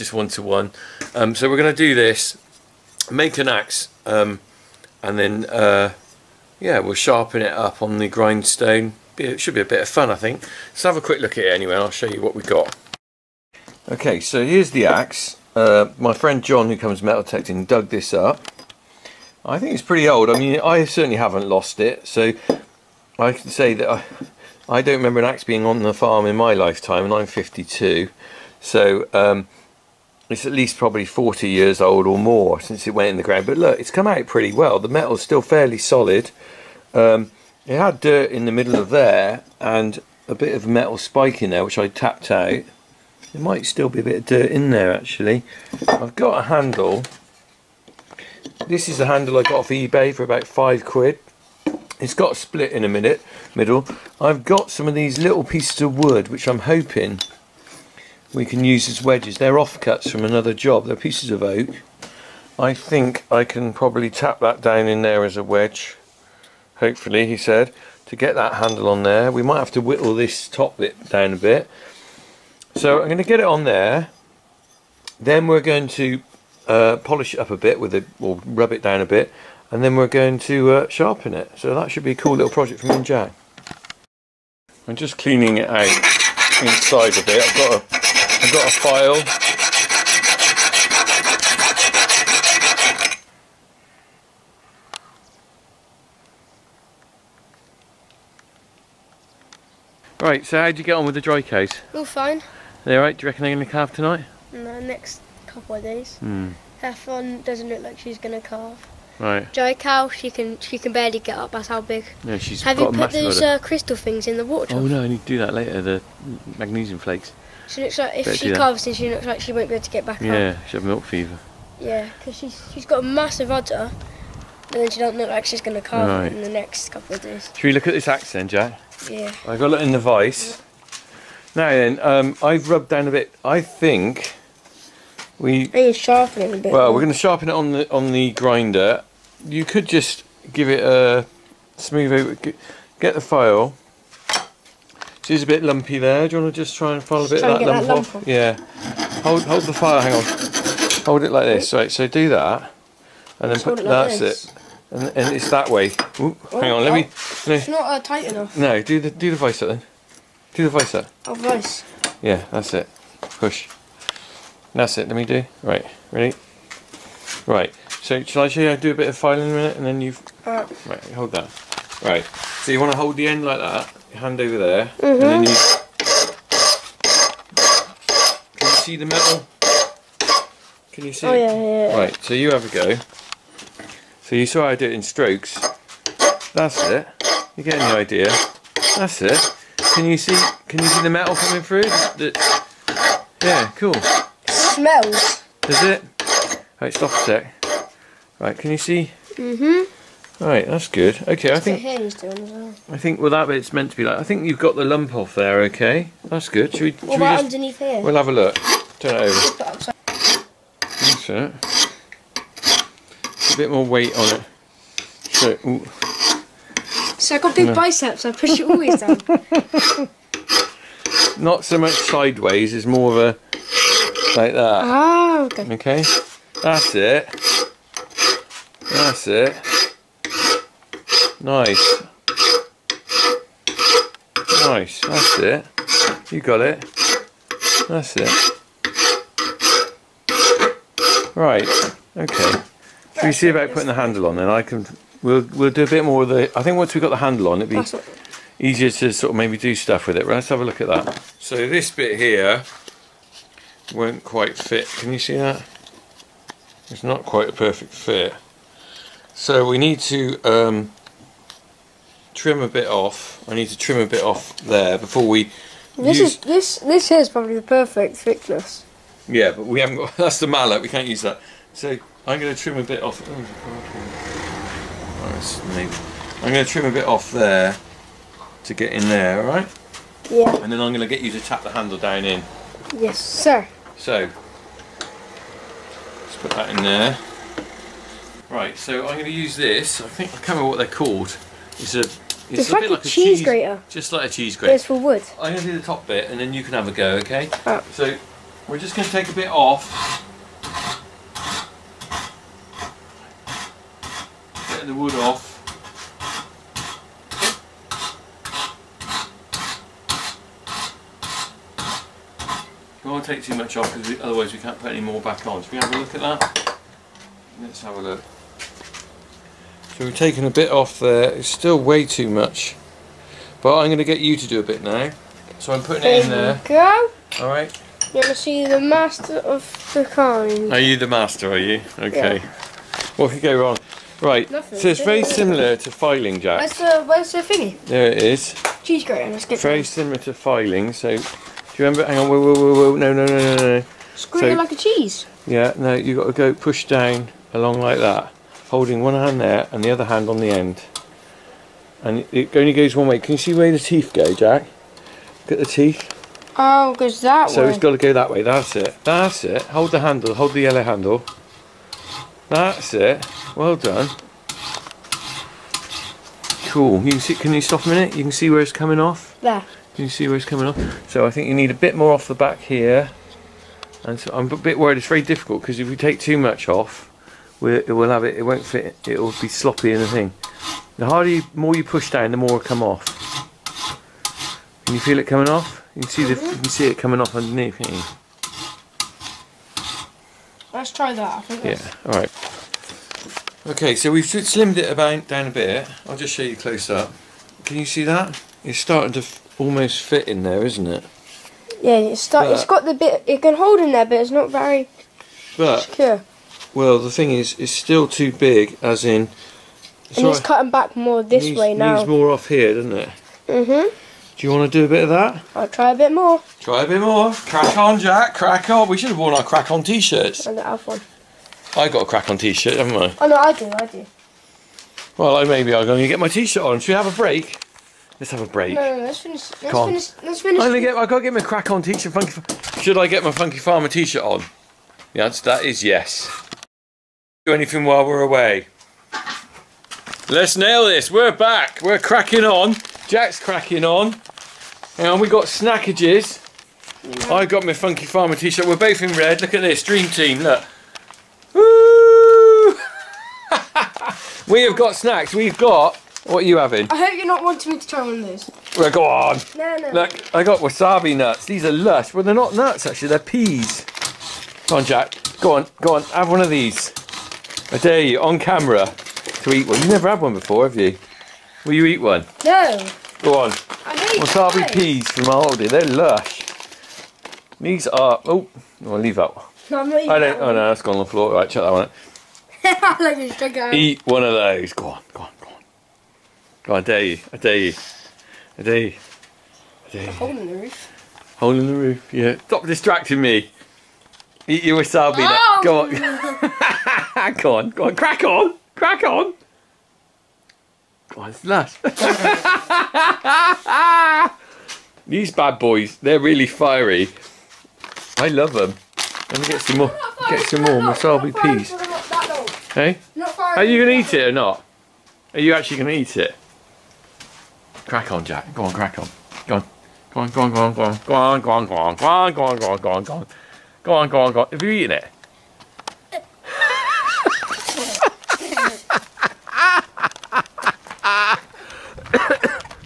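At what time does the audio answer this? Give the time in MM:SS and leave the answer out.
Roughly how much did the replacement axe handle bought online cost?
00:50.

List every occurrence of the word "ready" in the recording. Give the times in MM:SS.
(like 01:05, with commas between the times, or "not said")
02:46.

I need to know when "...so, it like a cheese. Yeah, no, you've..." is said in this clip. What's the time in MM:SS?
05:44.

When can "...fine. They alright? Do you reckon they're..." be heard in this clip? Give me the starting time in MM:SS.
01:42.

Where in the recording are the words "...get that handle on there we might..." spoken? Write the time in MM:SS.
01:08.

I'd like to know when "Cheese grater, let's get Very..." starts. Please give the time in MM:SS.
05:38.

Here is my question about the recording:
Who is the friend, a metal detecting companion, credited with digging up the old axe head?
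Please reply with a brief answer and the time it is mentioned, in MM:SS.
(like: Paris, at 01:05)
John, at 00:16.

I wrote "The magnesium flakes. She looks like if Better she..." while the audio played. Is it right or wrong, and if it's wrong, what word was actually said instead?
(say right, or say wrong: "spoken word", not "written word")
right.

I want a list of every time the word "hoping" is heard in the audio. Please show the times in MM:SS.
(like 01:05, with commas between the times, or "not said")
00:56.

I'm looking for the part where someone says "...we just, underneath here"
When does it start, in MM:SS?
03:27.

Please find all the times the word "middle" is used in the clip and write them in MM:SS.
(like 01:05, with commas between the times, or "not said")
00:38, 00:53.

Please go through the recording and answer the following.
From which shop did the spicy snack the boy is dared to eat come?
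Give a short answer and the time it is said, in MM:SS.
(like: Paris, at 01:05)
Aldi, at 07:55.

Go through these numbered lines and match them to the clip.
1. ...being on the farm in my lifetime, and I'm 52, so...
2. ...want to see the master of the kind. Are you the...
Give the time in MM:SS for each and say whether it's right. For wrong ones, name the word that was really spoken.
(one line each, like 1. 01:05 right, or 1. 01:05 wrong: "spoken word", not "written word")
1. 00:25 right
2. 05:28 right.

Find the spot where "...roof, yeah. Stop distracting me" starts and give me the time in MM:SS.
08:11.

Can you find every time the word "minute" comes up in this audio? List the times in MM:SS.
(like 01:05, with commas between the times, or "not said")
00:52, 02:49, 06:07.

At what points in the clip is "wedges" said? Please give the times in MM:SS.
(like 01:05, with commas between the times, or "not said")
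00:59, 01:05.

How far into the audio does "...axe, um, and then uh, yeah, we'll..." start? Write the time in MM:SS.
00:03.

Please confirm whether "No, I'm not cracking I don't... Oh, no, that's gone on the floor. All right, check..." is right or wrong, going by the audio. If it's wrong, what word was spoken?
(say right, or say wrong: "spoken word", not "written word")
wrong: "eating", not "cracking".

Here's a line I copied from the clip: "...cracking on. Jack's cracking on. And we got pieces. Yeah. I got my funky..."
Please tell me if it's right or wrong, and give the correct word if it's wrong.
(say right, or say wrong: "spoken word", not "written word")
wrong: "snackages", not "pieces".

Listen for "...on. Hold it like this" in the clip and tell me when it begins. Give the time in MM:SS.
02:30.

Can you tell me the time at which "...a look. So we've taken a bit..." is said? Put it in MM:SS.
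05:17.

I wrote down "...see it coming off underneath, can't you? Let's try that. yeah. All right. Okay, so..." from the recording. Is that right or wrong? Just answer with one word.
right.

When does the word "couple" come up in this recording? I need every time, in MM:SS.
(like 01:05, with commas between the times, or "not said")
01:45, 02:06.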